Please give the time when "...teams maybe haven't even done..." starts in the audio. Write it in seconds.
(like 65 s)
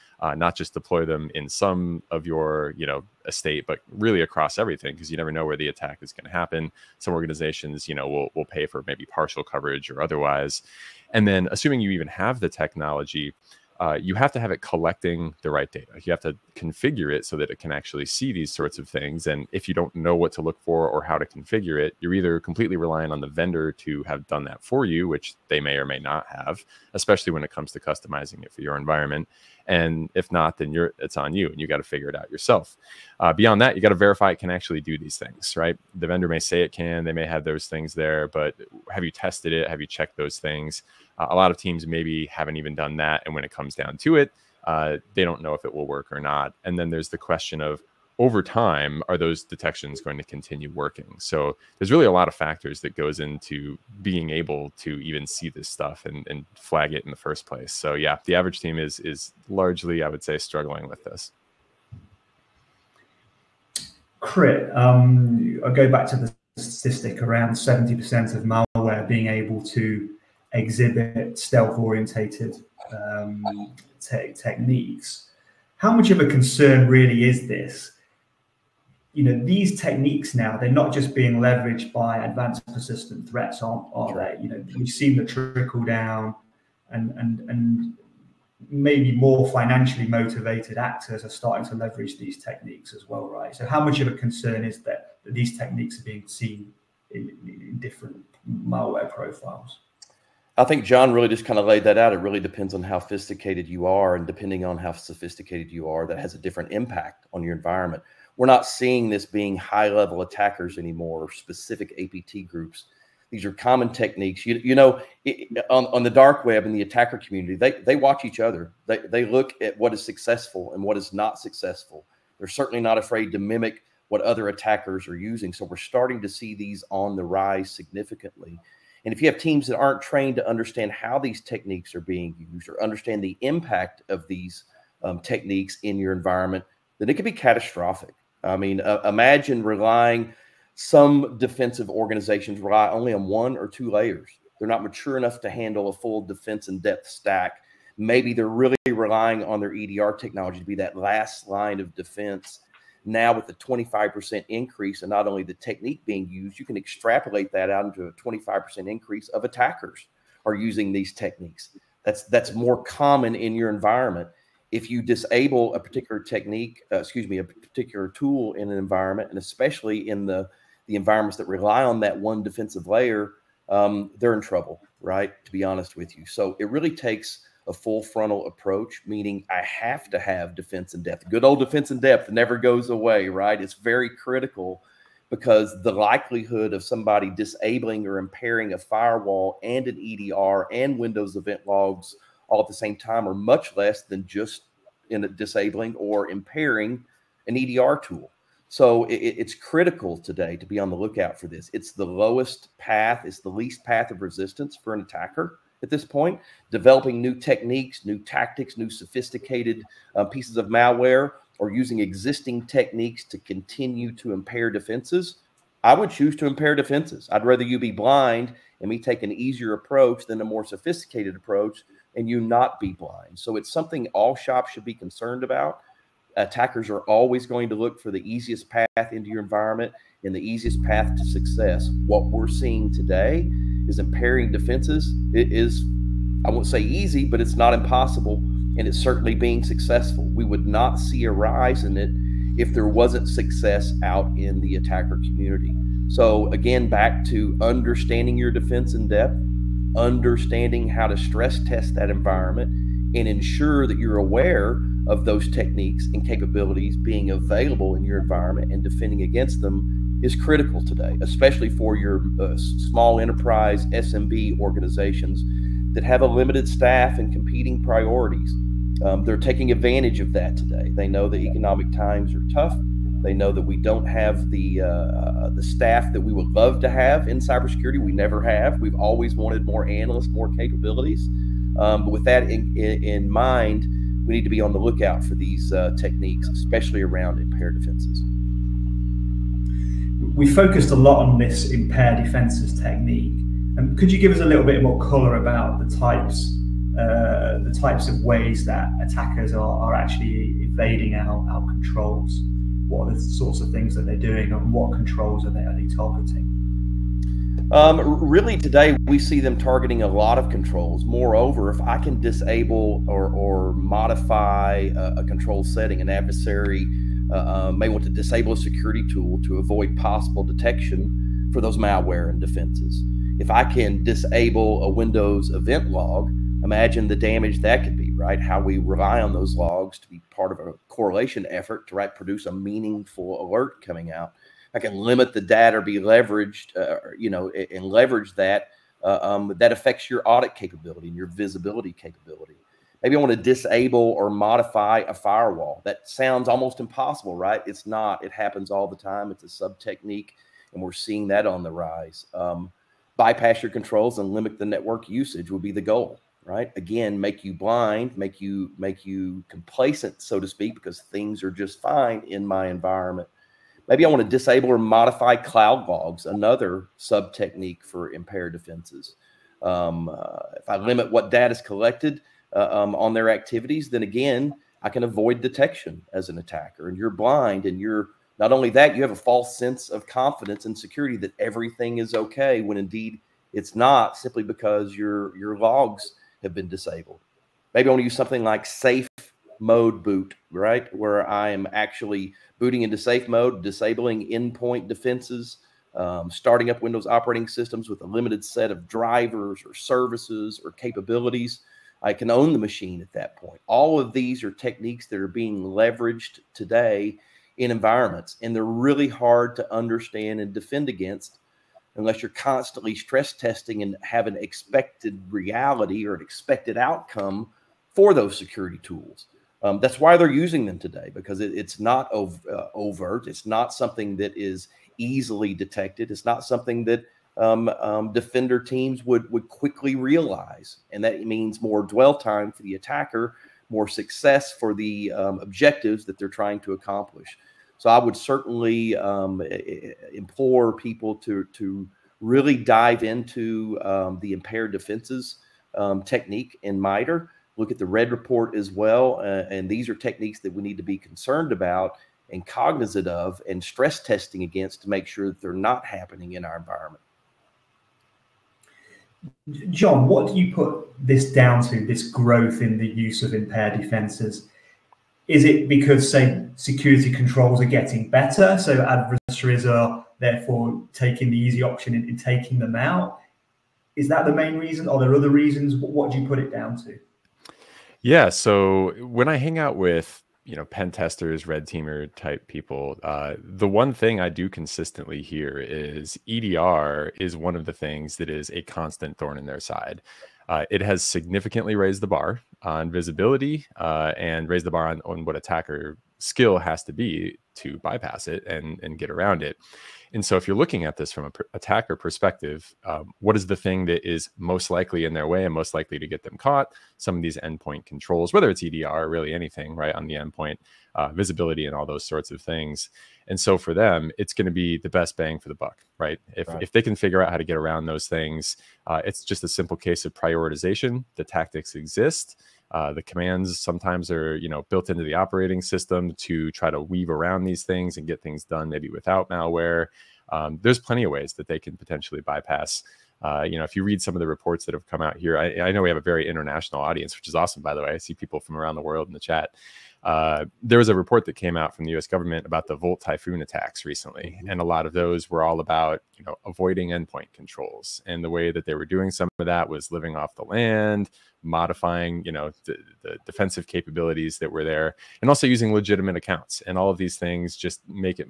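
41 s.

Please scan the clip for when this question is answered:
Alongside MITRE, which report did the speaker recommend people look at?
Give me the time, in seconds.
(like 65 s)
447 s.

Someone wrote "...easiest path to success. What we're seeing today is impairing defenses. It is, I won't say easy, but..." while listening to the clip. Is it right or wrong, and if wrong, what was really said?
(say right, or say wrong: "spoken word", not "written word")
right.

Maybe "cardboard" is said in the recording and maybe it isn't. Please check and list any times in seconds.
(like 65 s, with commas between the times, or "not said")
not said.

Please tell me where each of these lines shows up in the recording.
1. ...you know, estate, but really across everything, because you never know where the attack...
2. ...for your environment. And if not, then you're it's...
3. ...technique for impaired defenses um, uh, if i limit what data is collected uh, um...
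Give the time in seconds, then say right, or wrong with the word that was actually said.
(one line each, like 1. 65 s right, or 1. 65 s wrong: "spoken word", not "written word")
1. 2 s right
2. 28 s right
3. 367 s right.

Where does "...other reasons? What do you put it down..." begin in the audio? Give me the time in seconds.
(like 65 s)
475 s.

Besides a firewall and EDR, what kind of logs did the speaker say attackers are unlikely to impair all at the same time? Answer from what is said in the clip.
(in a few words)
Windows event logs.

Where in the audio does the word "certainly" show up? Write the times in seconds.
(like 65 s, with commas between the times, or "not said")
122 s, 238 s, 438 s.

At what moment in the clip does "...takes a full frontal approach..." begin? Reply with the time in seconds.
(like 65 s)
176 s.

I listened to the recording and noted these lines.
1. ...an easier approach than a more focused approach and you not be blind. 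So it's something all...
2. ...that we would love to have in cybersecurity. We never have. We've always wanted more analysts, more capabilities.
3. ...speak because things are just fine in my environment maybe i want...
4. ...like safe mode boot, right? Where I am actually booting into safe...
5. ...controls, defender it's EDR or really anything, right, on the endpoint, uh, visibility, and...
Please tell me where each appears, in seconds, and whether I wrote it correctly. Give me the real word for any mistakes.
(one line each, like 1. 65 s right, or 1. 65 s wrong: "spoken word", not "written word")
1. 219 s wrong: "sophisticated", not "focused"
2. 276 s right
3. 360 s right
4. 388 s right
5. 507 s wrong: "whether", not "defender".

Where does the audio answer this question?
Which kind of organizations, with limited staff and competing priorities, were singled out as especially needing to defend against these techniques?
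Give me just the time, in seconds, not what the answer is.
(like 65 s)
263 s.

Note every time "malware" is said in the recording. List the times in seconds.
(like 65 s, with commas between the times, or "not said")
68 s, 98 s, 210 s, 321 s, 529 s.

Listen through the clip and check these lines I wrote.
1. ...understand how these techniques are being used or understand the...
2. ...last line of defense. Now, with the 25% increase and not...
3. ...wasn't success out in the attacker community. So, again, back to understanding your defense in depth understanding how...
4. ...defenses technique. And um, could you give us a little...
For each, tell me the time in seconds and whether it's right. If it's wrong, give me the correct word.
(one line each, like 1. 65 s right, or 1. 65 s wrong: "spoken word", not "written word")
1. 130 s right
2. 150 s right
3. 242 s right
4. 292 s right.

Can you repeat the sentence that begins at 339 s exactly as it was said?
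Uh, um, that affects your audit capability and your visibility capability.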